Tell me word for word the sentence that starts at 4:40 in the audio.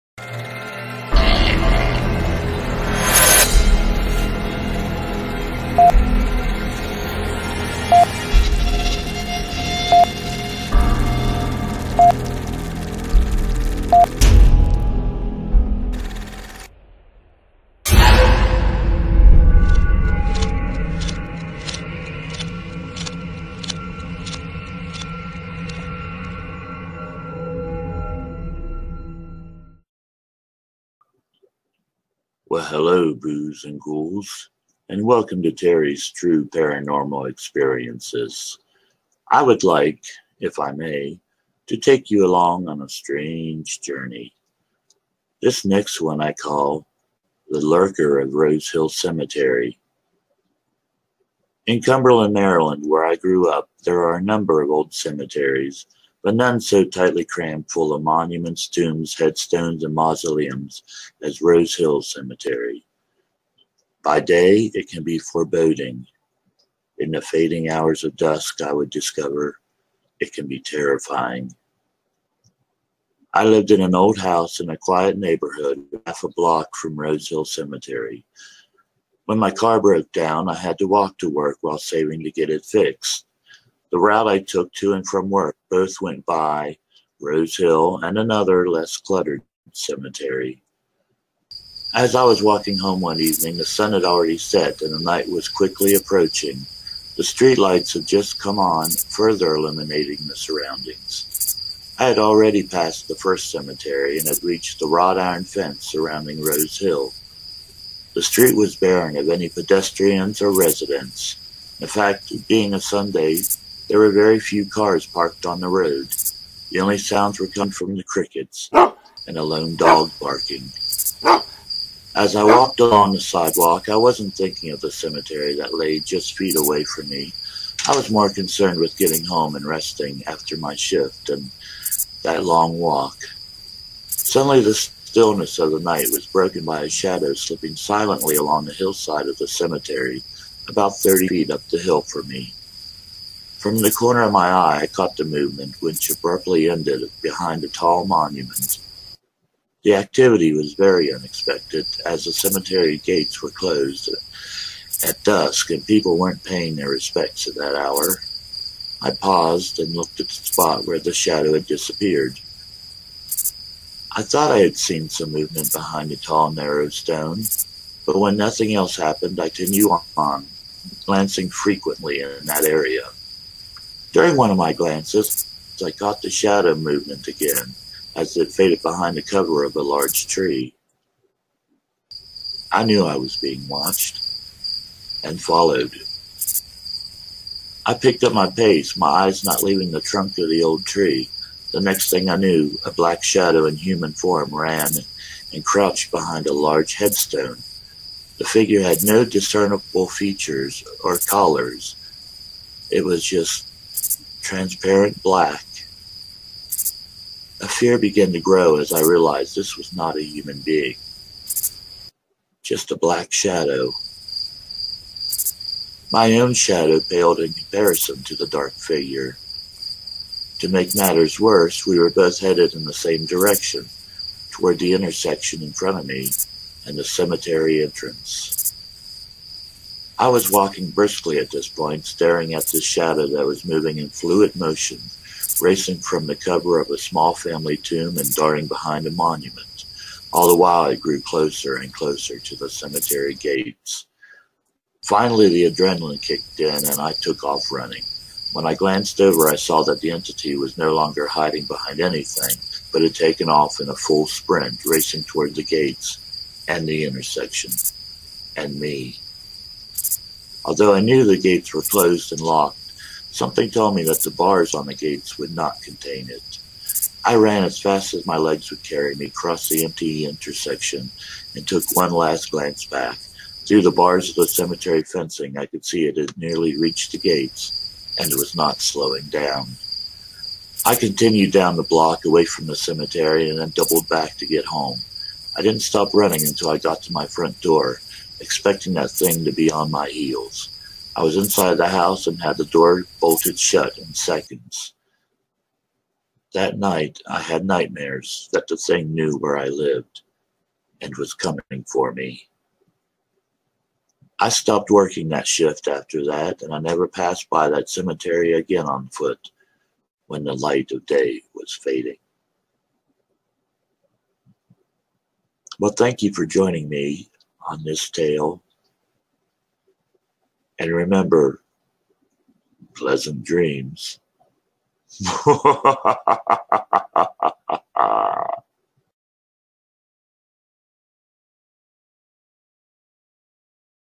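I continued down the block away from the cemetery and then doubled back to get home.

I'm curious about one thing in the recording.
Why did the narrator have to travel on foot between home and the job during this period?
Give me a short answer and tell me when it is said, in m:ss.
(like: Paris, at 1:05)
car broke down, at 1:19.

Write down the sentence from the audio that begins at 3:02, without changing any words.
I knew I was being watched and followed.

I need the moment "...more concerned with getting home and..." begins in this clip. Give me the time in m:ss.
2:08.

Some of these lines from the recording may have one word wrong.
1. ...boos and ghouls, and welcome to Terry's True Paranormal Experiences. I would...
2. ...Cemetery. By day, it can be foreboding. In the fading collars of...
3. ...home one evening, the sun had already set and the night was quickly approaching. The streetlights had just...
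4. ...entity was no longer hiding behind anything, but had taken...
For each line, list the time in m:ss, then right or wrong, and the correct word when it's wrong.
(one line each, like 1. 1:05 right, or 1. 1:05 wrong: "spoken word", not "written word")
1. 0:33 right
2. 1:02 wrong: "hours", not "collars"
3. 1:32 right
4. 4:10 right.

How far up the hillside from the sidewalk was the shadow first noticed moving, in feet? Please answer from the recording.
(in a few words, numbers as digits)
30 feet.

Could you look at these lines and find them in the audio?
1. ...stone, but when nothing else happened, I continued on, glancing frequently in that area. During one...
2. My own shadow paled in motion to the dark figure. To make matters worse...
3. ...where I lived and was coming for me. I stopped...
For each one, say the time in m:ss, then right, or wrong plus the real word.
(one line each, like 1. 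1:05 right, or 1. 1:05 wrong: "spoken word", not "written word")
1. 2:46 right
2. 3:36 wrong: "comparison", not "motion"
3. 4:59 right.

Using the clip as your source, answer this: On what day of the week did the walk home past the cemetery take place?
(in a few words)
Sunday.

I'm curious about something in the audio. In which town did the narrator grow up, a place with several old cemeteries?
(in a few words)
Cumberland, Maryland.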